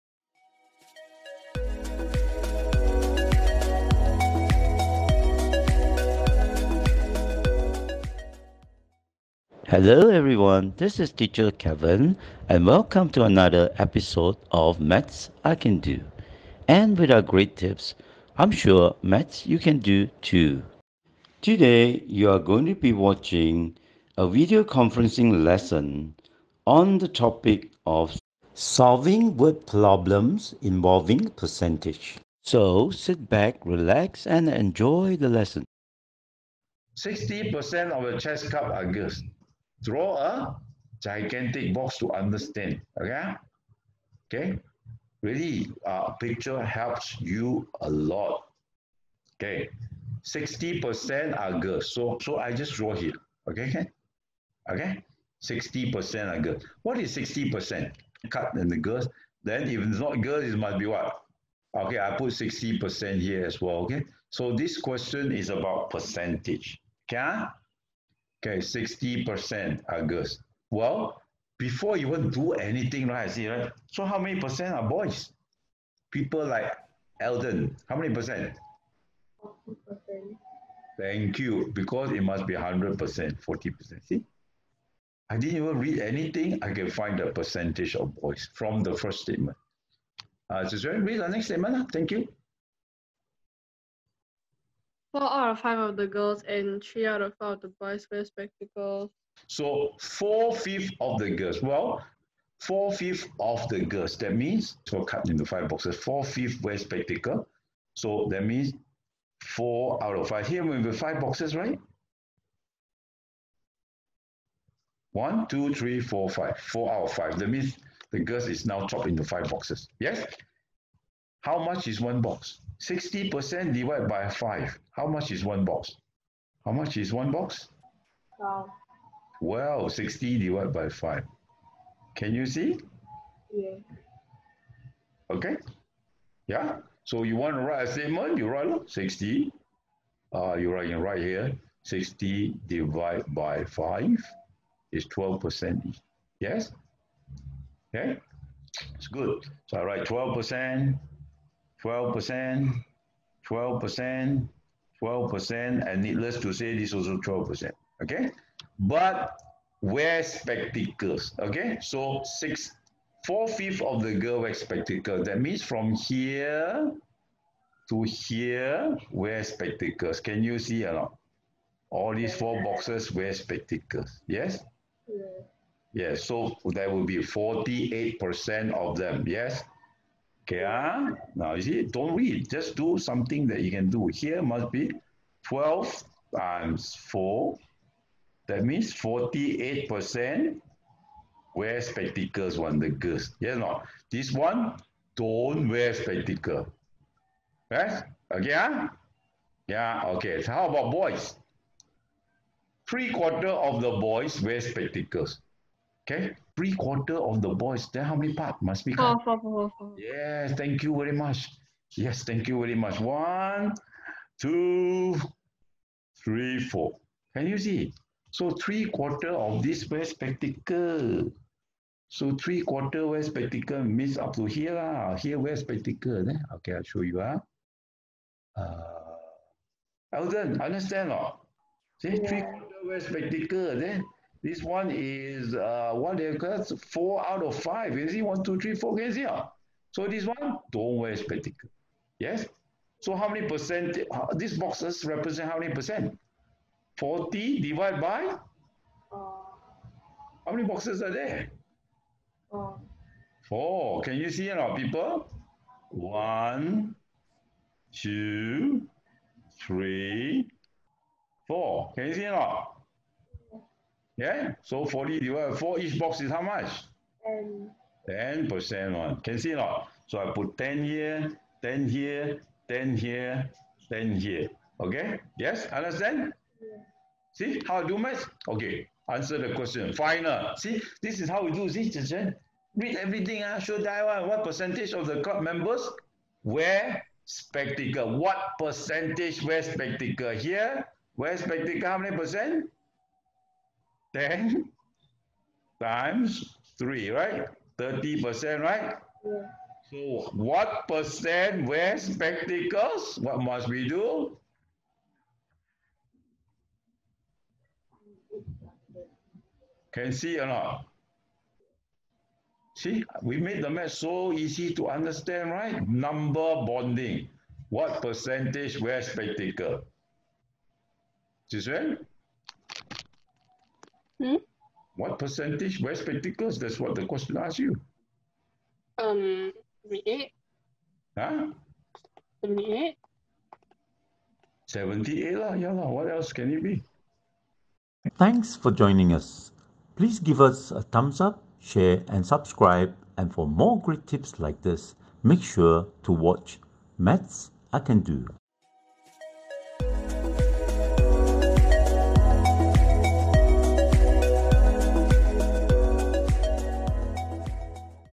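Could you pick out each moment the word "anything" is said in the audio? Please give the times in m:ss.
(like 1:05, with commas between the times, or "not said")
1:12, 1:25.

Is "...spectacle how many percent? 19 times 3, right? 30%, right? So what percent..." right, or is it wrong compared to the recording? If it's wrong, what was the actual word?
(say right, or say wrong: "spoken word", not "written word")
wrong: "10", not "19".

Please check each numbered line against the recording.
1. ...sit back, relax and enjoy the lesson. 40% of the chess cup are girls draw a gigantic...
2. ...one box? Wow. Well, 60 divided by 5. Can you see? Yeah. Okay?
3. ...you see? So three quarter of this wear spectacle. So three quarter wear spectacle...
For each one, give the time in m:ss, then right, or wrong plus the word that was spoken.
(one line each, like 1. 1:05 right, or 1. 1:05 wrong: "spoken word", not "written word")
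1. 0:32 wrong: "60", not "40"
2. 2:07 right
3. 3:37 right.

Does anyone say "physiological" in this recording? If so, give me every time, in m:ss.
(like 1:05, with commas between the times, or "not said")
not said.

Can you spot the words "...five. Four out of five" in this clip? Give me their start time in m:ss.
1:56.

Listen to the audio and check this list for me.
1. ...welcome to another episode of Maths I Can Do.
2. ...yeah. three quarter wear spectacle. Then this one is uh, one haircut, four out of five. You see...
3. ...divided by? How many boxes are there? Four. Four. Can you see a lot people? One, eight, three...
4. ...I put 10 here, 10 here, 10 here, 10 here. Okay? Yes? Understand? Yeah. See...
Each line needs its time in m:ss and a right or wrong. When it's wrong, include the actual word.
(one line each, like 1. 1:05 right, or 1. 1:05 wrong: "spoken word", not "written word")
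1. 0:12 right
2. 3:52 right
3. 4:07 wrong: "two", not "eight"
4. 4:30 right.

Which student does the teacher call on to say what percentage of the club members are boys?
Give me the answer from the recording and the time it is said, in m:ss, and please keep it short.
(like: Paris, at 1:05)
Eldon, at 1:17.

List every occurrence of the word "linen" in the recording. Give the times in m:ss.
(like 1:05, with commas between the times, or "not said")
not said.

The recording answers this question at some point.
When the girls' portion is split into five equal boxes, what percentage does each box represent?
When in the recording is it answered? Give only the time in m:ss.
2:21.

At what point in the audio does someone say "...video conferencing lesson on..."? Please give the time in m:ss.
0:24.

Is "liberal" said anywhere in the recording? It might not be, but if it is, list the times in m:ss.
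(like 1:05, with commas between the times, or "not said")
not said.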